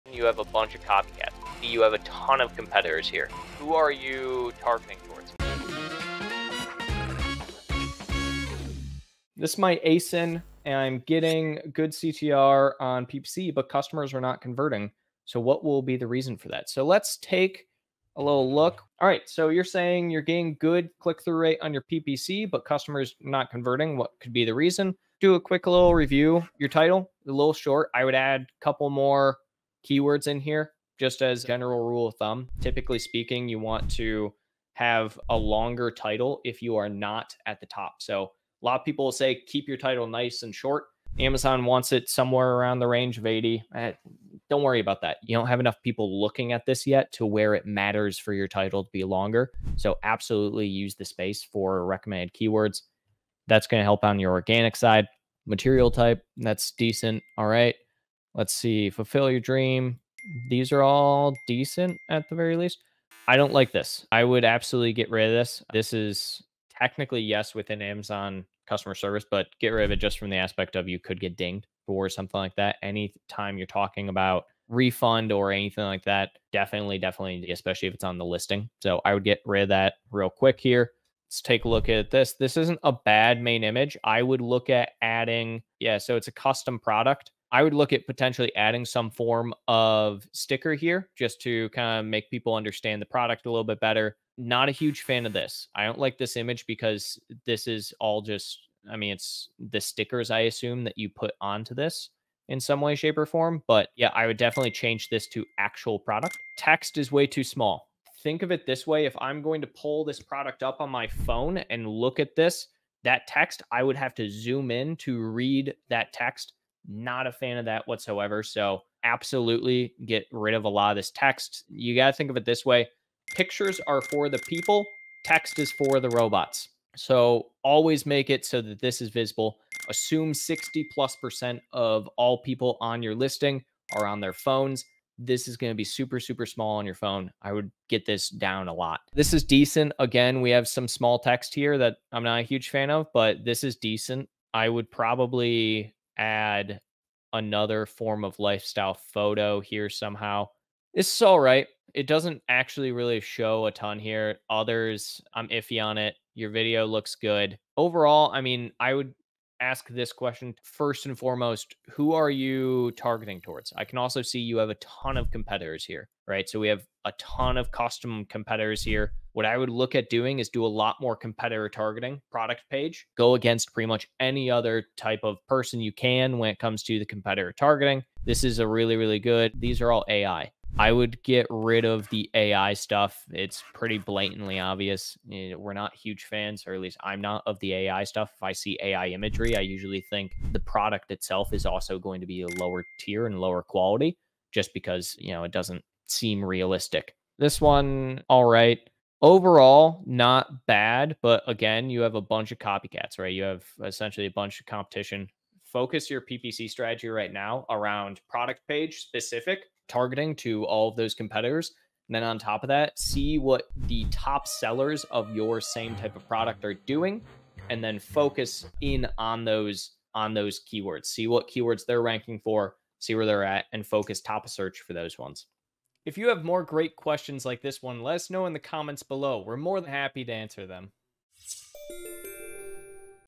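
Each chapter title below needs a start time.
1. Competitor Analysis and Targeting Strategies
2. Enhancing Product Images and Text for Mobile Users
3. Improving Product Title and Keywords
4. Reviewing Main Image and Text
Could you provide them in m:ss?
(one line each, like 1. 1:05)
1. 2:41
2. 1:35
3. 0:26
4. 0:51.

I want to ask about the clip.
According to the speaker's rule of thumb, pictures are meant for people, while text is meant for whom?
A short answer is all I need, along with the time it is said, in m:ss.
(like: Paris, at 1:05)
the robots, at 2:05.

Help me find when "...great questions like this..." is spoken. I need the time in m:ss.
3:46.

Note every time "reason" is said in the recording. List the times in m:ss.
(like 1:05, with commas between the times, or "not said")
0:16, 0:24.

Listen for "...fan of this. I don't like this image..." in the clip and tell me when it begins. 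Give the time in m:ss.
1:35.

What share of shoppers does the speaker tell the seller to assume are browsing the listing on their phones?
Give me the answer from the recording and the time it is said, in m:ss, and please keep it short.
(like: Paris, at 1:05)
60 plus percent, at 2:10.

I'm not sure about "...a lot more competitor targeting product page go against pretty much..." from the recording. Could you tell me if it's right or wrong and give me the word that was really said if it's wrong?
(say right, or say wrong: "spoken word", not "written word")
right.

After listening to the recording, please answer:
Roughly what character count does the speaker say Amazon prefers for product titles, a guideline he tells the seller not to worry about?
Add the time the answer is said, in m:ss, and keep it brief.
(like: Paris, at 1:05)
80, at 0:43.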